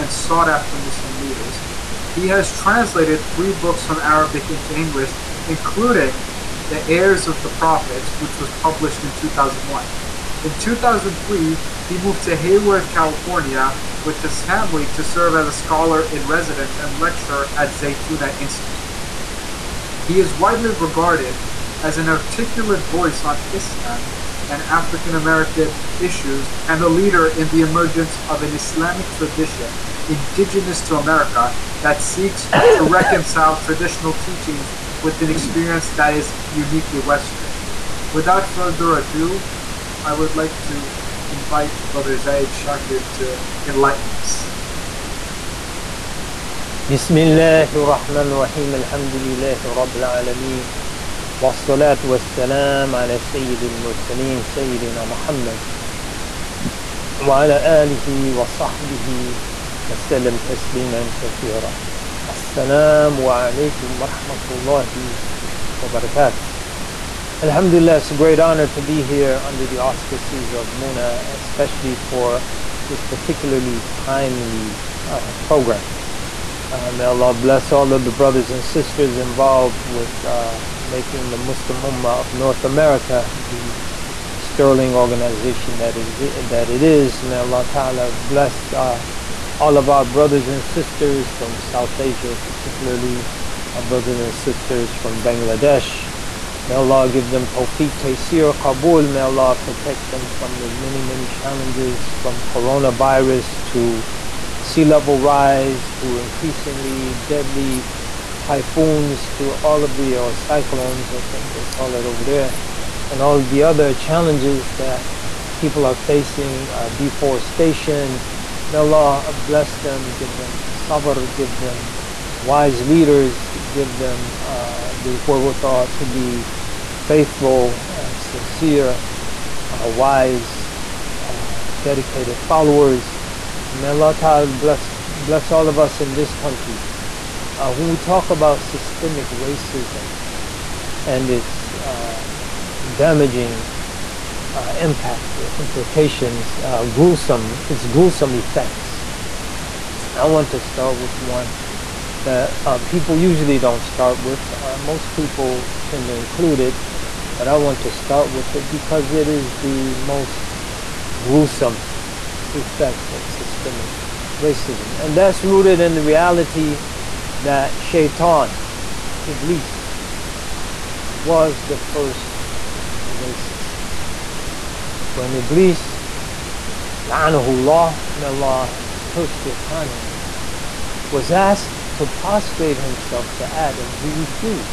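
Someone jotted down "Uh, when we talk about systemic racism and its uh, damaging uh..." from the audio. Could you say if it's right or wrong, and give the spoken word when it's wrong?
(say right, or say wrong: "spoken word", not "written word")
right.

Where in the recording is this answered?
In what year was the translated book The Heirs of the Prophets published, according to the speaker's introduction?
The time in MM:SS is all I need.
00:09.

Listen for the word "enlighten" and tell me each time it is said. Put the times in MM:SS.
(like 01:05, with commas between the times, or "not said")
00:43.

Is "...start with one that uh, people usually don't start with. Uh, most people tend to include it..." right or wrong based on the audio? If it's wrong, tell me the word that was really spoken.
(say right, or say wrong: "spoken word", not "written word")
right.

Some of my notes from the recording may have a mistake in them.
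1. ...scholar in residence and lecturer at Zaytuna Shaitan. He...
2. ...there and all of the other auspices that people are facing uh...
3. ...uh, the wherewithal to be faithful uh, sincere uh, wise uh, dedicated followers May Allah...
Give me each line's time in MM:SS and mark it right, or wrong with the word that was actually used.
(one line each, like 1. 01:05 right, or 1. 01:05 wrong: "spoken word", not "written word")
1. 00:15 wrong: "Institute", not "Shaitan"
2. 01:52 wrong: "challenges", not "auspices"
3. 02:04 right.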